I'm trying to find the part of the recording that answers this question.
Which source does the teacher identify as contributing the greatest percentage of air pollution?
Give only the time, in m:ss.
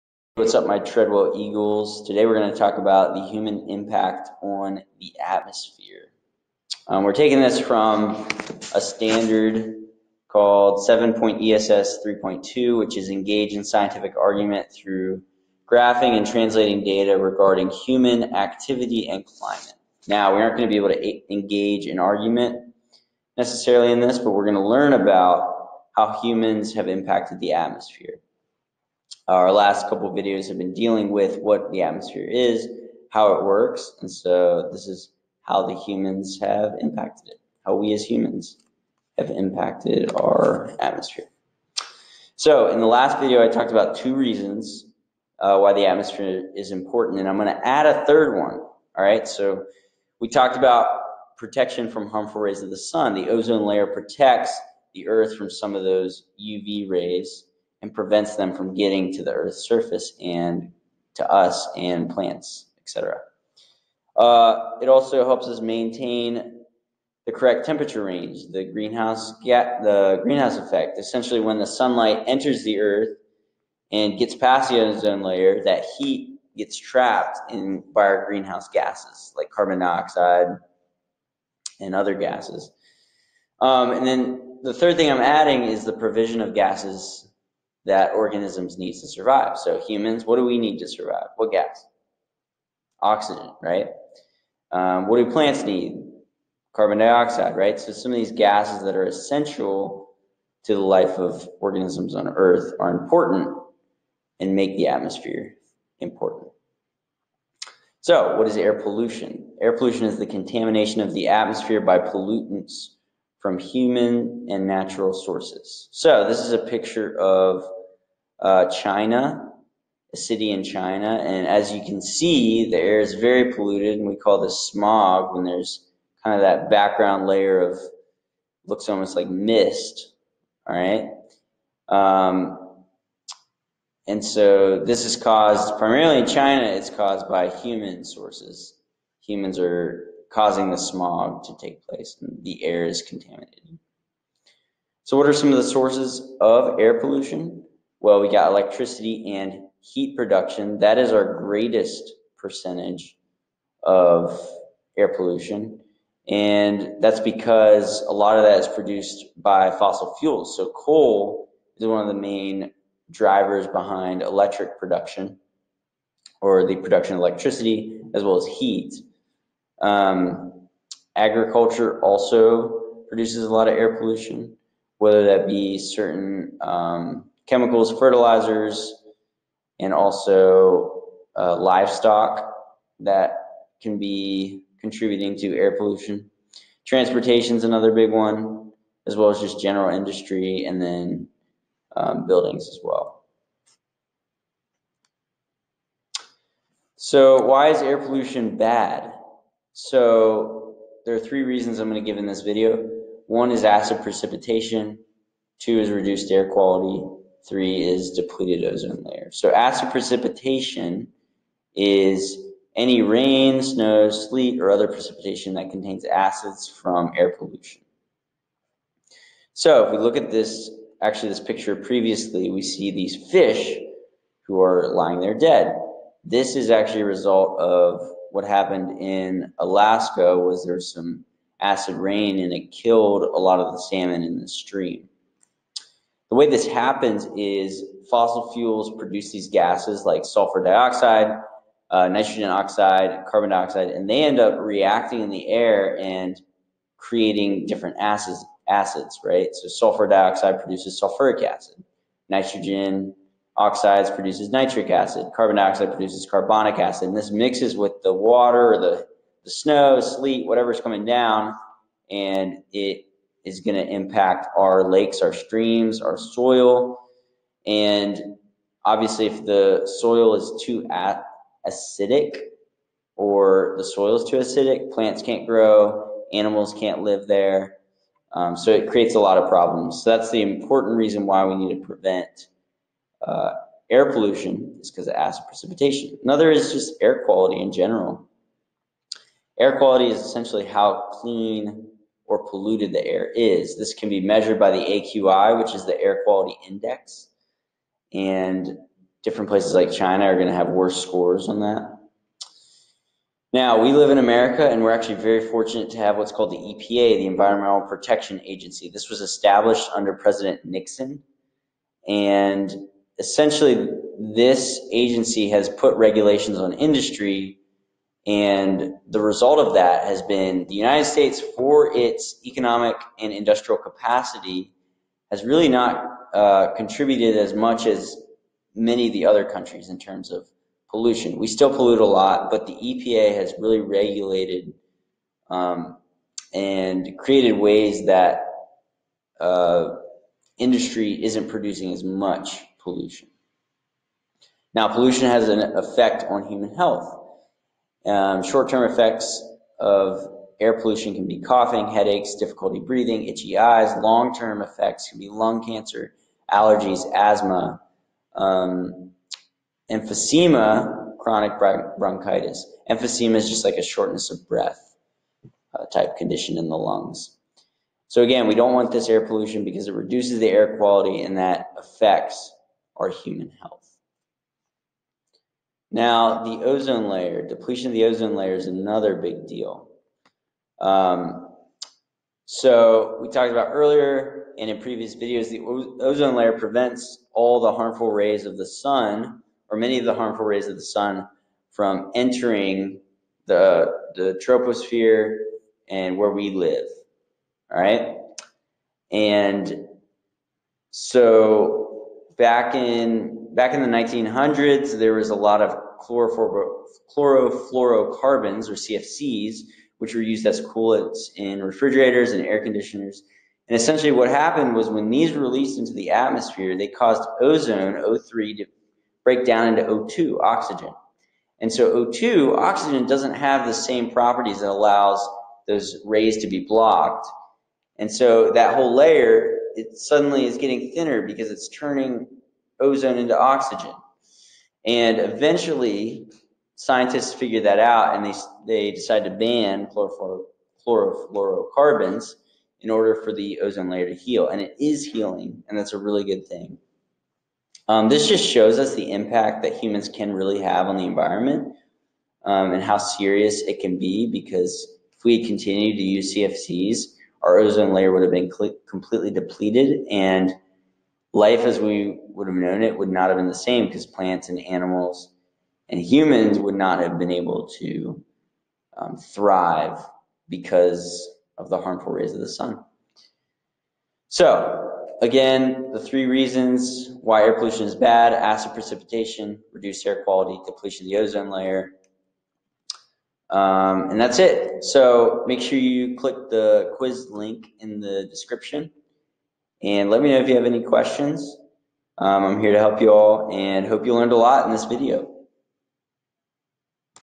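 2:28.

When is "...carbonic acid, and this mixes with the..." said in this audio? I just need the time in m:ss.
4:16.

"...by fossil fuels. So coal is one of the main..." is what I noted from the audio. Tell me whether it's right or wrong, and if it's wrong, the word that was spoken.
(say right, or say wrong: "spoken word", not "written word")
right.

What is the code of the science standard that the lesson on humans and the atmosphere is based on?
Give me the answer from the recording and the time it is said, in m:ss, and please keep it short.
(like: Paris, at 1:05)
7.0 ESS 3.2, at 0:10.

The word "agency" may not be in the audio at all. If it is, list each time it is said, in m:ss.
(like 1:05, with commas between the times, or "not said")
5:08, 5:14.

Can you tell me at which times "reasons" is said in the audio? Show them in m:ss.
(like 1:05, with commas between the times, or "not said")
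0:44, 3:21, 4:40, 7:56.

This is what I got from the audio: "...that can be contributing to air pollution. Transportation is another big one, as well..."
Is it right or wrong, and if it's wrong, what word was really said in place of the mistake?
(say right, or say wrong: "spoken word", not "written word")
right.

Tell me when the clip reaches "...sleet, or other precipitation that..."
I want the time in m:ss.
3:34.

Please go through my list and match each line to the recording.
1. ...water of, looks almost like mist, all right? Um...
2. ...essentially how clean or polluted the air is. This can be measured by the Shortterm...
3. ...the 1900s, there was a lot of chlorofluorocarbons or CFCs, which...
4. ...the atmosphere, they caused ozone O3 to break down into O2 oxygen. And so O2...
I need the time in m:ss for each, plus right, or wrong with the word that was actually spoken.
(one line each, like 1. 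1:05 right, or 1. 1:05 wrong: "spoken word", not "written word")
1. 2:07 wrong: "layer", not "water"
2. 4:50 wrong: "AQI", not "Shortterm"
3. 6:43 right
4. 6:55 right.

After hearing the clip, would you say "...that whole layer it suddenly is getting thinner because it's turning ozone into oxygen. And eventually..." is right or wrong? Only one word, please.
right.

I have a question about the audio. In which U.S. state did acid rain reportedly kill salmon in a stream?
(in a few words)
Alaska.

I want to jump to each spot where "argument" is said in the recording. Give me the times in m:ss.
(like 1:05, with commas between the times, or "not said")
0:14, 0:21.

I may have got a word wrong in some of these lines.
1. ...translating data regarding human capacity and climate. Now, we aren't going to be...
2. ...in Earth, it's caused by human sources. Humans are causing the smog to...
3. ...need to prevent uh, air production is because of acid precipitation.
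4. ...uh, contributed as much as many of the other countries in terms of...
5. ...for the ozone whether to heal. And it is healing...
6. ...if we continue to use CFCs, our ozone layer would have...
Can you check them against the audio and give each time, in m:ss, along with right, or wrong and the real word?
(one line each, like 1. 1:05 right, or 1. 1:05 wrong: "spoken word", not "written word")
1. 0:16 wrong: "activity", not "capacity"
2. 2:16 wrong: "China", not "Earth"
3. 4:41 wrong: "pollution", not "production"
4. 5:26 right
5. 7:23 wrong: "layer", not "whether"
6. 7:35 right.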